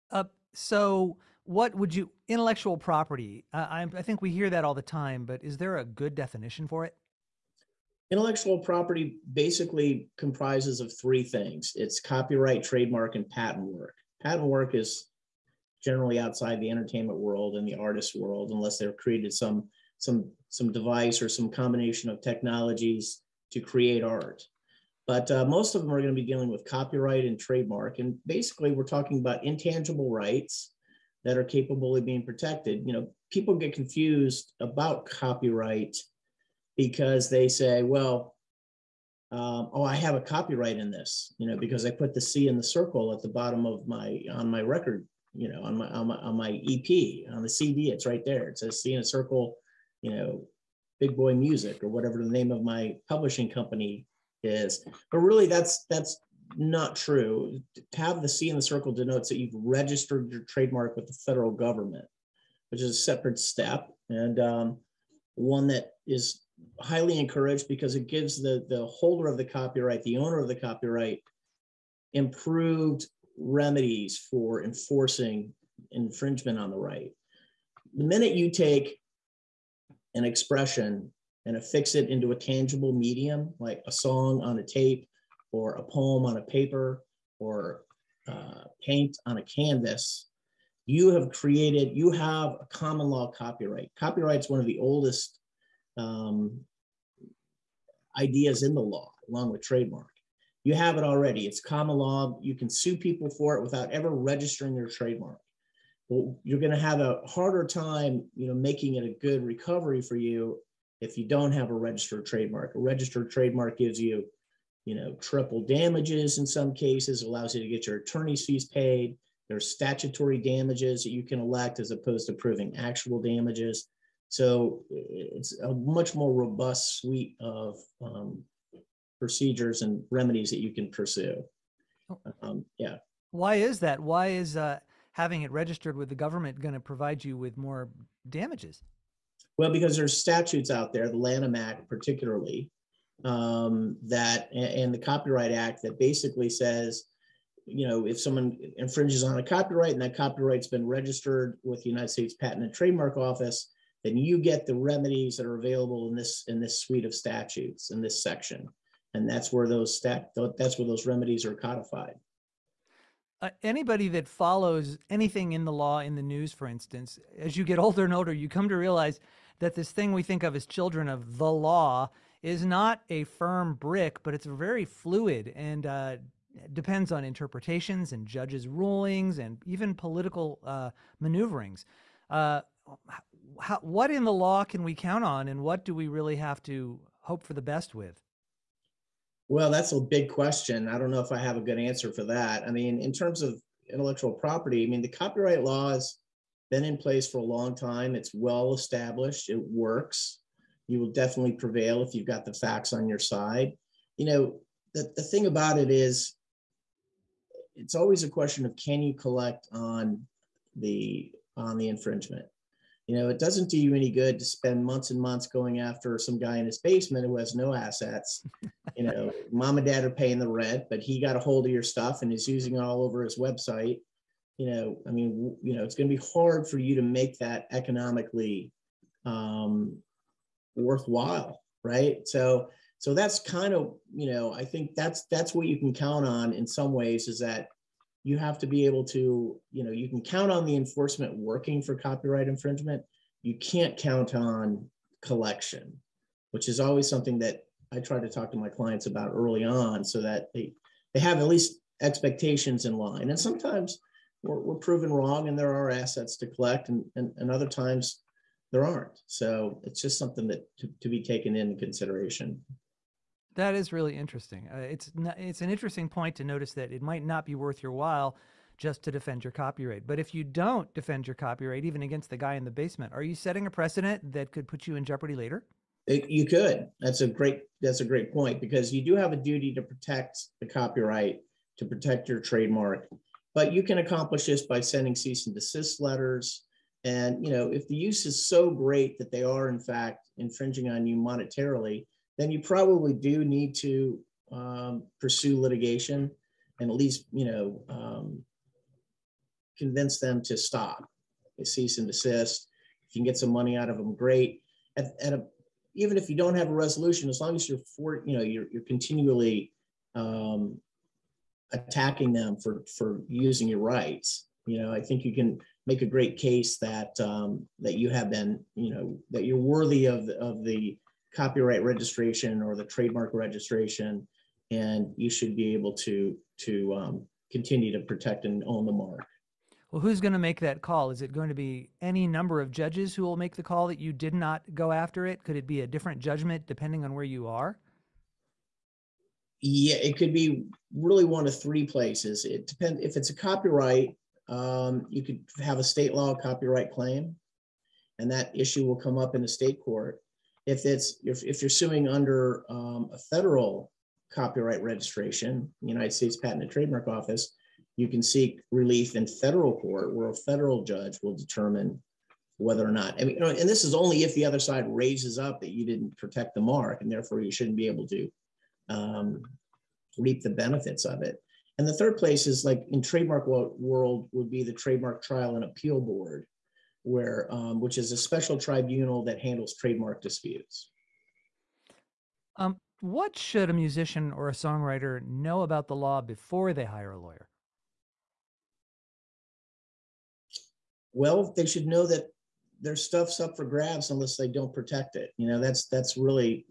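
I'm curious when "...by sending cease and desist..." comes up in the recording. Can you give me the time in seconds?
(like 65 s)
284 s.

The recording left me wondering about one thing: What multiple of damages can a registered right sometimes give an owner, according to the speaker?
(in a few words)
triple damages.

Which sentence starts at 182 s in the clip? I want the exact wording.
Uh, how, what in the law can we count on and what do we really have to hope for the best with?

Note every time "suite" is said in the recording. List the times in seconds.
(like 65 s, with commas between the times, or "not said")
126 s, 156 s.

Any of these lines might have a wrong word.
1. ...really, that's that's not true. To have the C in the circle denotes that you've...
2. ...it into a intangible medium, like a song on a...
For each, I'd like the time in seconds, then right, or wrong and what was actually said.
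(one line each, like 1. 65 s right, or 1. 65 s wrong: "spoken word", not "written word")
1. 55 s right
2. 81 s wrong: "tangible", not "intangible".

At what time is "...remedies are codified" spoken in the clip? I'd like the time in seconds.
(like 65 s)
161 s.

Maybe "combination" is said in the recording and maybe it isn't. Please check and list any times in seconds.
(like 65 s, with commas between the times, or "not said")
21 s.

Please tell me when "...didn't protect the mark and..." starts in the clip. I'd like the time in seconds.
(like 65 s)
365 s.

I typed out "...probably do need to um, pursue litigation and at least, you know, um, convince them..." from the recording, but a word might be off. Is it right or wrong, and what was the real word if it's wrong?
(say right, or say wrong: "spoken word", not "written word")
right.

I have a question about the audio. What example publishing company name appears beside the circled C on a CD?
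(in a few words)
Big Boy Music.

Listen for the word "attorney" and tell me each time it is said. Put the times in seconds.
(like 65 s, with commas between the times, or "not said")
117 s.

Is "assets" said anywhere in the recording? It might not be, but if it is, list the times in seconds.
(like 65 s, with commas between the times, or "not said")
217 s, 255 s.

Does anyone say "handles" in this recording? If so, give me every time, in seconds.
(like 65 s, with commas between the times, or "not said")
379 s.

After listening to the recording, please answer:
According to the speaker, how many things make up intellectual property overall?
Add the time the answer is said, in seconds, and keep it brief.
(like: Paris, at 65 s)
3, at 10 s.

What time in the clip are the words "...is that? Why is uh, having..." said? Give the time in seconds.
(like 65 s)
133 s.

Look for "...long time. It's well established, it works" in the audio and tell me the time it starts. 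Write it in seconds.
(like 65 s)
197 s.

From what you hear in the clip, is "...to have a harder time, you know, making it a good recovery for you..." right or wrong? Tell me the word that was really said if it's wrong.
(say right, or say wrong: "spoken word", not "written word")
right.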